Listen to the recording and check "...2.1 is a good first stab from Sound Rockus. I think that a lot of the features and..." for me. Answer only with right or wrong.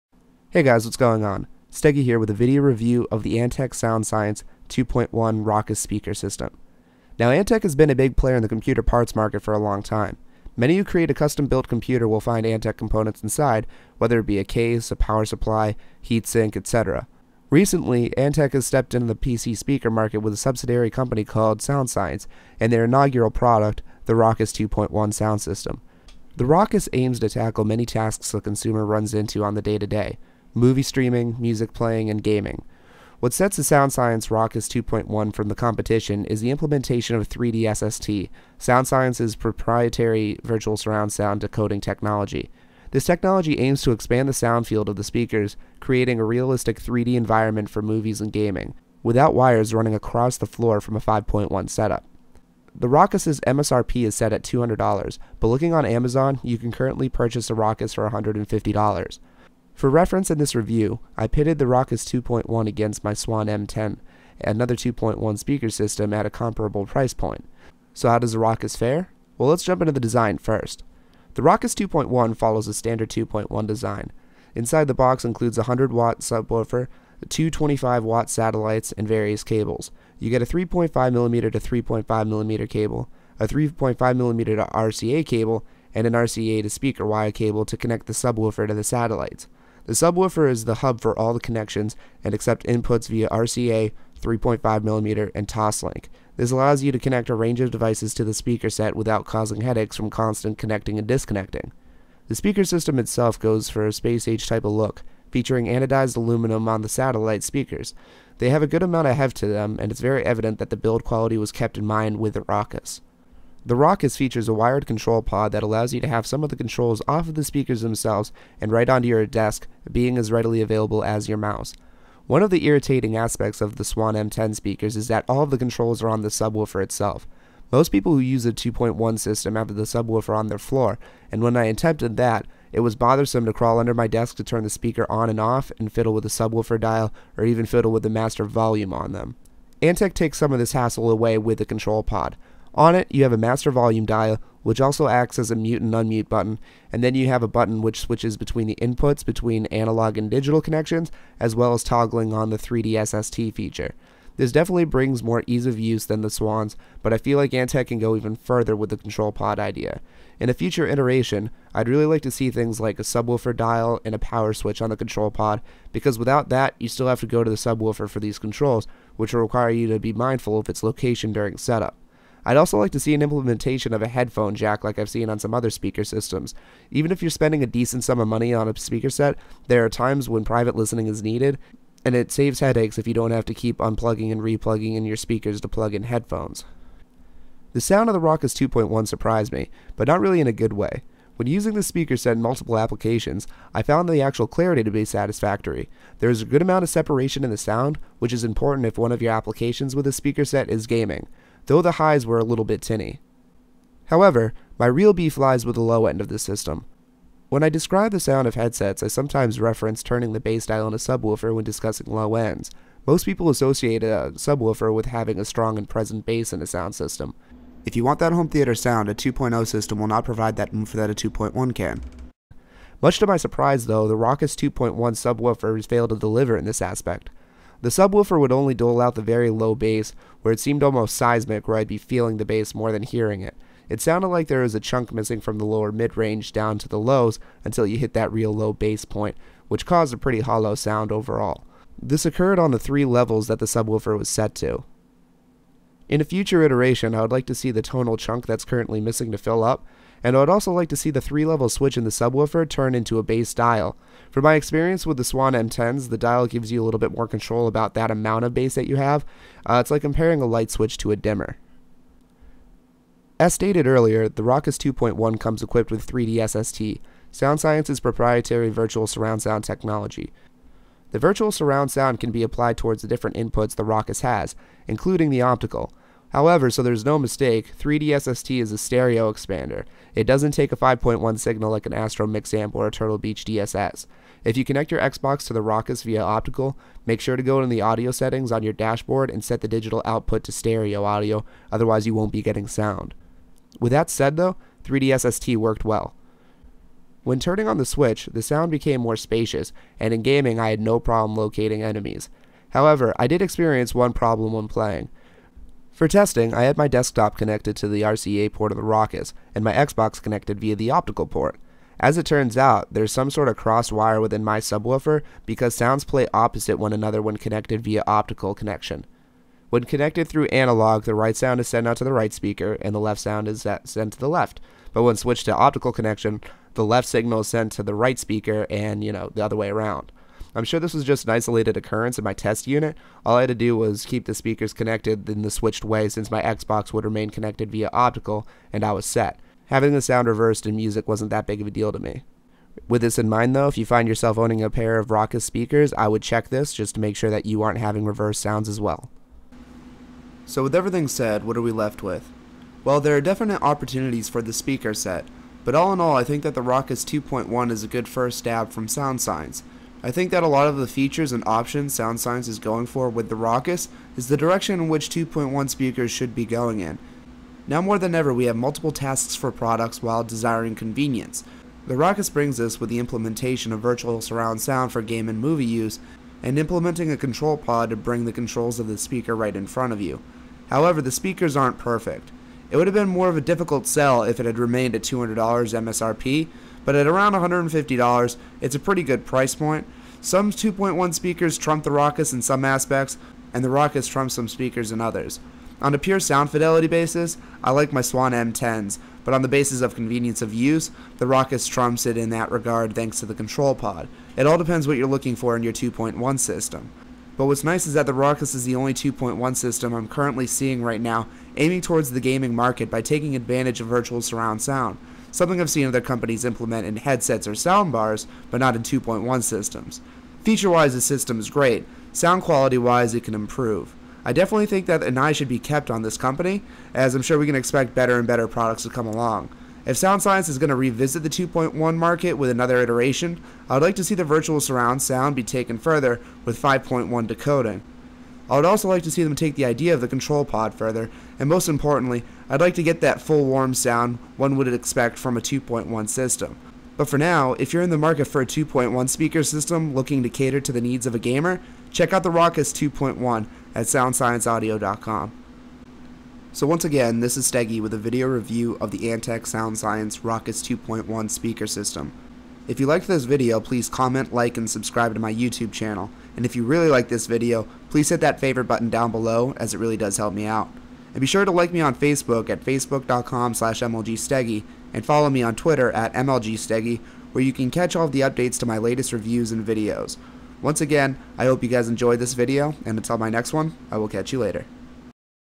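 wrong.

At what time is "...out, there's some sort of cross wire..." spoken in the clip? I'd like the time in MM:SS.
05:12.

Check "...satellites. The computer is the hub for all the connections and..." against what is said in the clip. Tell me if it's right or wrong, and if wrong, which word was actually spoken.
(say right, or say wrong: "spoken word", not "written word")
wrong: "subwoofer", not "computer".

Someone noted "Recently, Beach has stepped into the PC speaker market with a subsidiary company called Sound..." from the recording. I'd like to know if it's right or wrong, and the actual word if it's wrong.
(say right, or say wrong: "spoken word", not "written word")
wrong: "Antec", not "Beach".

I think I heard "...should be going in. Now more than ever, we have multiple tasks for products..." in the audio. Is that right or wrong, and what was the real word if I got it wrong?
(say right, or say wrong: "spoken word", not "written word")
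right.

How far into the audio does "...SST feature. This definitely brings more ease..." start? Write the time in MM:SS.
02:33.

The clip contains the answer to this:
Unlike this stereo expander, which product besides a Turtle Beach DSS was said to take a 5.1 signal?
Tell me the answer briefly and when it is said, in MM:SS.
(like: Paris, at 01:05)
Astro Amp, at 04:41.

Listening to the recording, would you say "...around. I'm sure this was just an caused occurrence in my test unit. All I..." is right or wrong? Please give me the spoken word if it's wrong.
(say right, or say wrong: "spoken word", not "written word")
wrong: "isolated", not "caused".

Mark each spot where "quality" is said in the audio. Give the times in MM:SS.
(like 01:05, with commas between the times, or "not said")
01:51, 07:02.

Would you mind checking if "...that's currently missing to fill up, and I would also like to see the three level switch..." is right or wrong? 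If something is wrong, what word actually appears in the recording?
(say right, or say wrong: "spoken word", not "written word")
right.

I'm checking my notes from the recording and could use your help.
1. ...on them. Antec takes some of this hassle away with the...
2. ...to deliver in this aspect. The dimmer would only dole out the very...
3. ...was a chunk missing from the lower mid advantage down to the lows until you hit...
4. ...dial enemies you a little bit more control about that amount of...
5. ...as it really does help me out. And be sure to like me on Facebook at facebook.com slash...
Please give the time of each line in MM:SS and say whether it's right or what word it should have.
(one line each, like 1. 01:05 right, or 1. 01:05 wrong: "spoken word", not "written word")
1. 02:18 right
2. 03:46 wrong: "subwoofer", not "dimmer"
3. 03:54 wrong: "range", not "advantage"
4. 04:16 wrong: "gives", not "enemies"
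5. 07:49 right.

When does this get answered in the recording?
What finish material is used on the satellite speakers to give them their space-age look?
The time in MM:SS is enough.
01:45.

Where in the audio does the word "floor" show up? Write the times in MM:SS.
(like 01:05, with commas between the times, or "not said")
00:50, 02:10.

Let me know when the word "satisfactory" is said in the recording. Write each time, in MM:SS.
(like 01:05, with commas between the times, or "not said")
03:15.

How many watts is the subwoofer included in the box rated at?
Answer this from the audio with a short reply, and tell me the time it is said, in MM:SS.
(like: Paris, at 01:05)
100 watts, at 01:15.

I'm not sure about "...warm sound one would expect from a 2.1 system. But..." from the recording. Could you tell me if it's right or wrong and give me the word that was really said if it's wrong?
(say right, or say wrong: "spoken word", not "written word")
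right.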